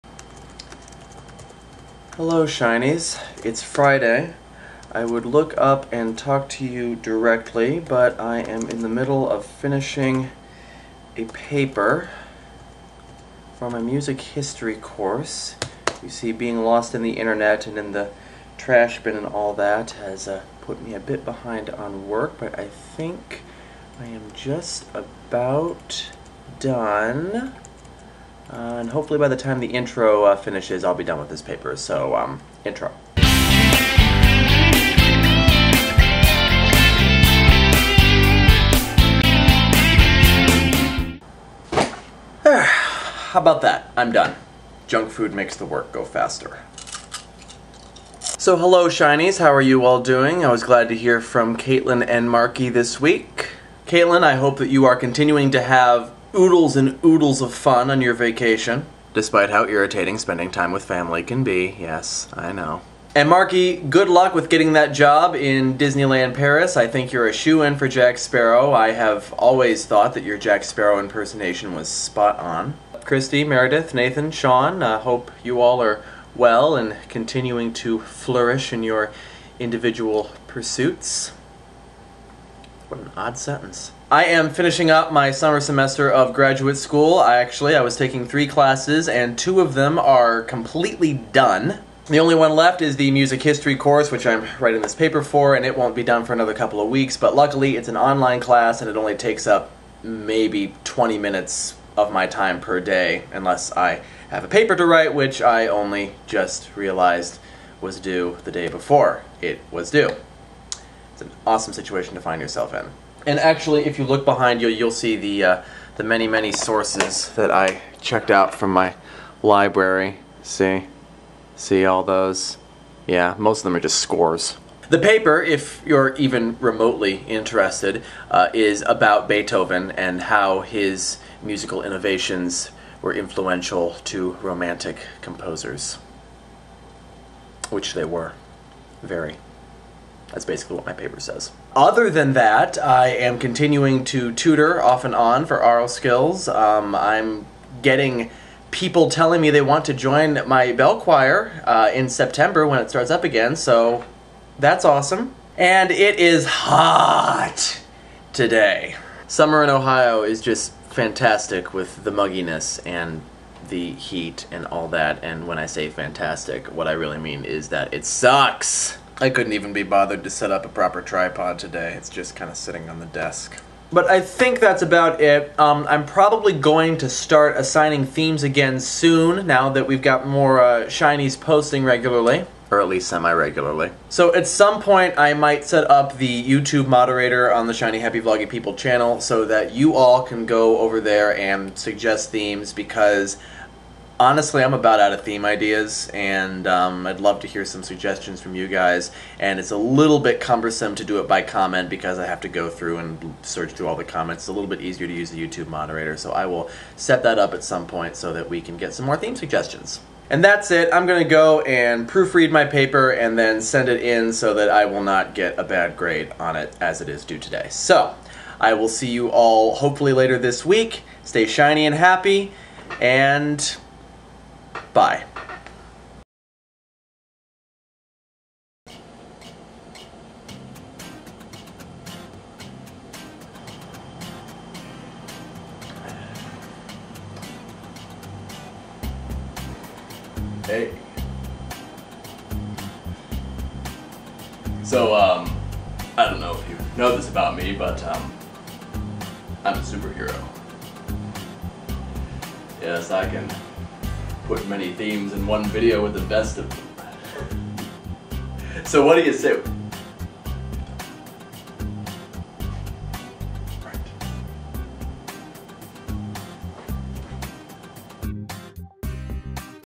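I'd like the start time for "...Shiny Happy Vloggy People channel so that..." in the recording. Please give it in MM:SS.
03:07.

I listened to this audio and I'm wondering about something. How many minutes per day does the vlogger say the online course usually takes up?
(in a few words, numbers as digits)
20.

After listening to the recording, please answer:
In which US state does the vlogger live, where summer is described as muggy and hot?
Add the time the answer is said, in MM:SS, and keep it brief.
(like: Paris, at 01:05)
Ohio, at 02:39.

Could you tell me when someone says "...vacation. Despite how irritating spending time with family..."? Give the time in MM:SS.
00:58.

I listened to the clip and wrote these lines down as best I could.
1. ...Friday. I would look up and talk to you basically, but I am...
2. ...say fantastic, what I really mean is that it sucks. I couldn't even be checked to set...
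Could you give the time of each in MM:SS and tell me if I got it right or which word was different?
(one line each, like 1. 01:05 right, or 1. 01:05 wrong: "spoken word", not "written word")
1. 00:03 wrong: "directly", not "basically"
2. 02:45 wrong: "bothered", not "checked".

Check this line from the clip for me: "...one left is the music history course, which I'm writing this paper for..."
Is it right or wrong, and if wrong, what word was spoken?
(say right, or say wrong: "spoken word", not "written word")
right.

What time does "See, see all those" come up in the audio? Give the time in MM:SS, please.
02:00.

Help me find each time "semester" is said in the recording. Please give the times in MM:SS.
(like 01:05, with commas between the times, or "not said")
01:25.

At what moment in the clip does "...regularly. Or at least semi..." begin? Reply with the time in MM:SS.
03:01.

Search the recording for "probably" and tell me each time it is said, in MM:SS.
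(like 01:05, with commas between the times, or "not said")
02:56.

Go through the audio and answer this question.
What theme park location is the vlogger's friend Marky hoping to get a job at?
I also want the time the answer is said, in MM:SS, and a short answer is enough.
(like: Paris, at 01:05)
Disneyland Paris, at 01:05.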